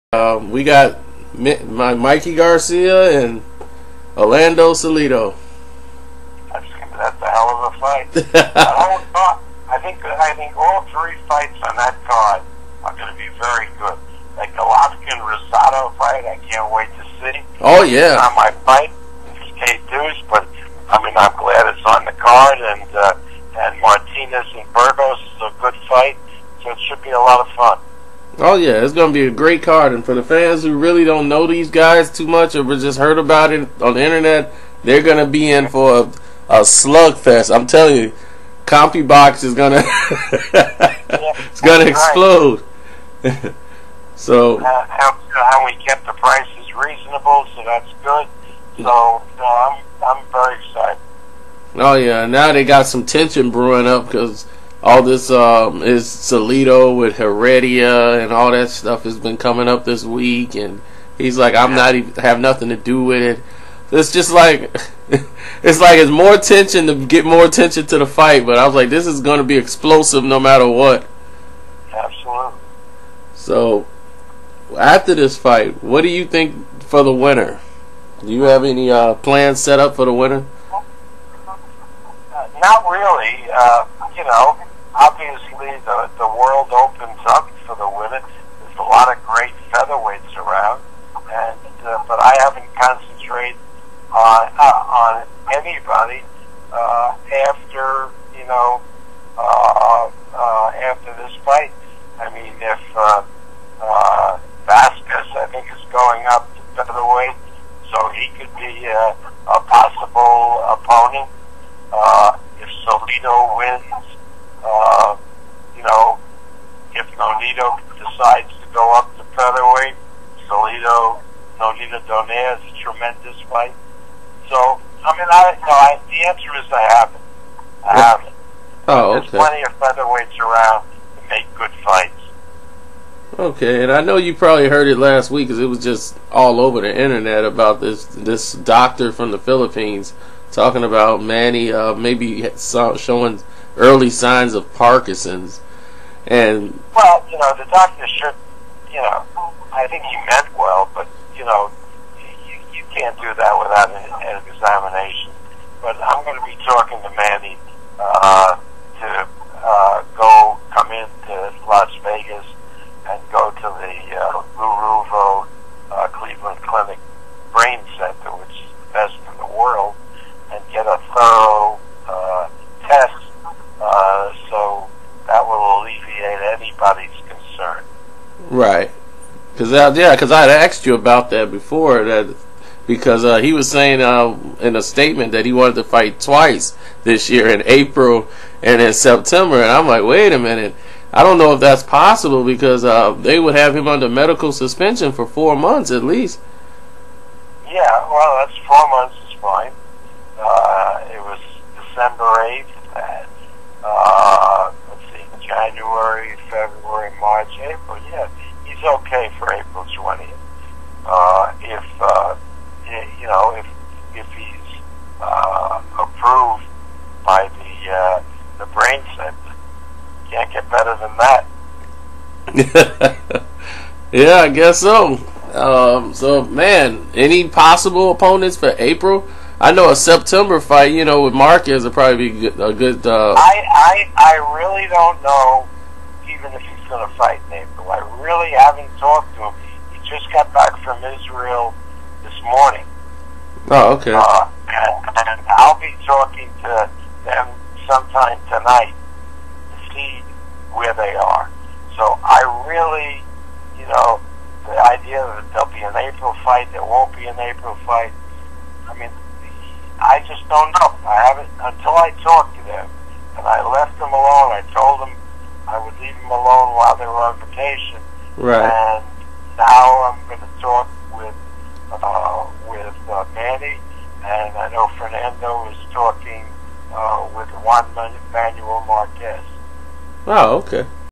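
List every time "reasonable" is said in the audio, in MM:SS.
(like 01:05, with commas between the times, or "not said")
00:46.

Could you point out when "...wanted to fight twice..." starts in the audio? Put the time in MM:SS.
03:05.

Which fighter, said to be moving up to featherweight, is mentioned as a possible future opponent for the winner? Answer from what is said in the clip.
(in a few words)
Vasquez.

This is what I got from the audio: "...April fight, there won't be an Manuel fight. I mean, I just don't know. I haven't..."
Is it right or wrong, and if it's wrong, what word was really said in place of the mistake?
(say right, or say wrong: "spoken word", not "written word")
wrong: "April", not "Manuel".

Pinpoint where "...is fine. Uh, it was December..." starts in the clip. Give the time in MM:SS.
03:19.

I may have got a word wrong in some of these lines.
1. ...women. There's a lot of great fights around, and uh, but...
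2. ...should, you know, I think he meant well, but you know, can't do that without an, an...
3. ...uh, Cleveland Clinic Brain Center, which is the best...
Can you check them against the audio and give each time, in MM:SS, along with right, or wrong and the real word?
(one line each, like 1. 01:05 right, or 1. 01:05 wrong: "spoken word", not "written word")
1. 01:27 wrong: "featherweights", not "fights"
2. 02:28 right
3. 02:44 right.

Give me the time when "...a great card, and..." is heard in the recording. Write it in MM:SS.
00:29.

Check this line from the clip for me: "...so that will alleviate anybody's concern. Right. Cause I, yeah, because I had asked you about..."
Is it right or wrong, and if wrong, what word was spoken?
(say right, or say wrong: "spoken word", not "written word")
right.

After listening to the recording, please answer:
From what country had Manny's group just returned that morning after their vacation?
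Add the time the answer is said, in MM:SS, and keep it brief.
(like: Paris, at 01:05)
Israel, at 04:01.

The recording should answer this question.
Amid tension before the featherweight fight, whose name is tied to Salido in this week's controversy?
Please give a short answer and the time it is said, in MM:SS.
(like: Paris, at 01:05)
Heredia, at 00:57.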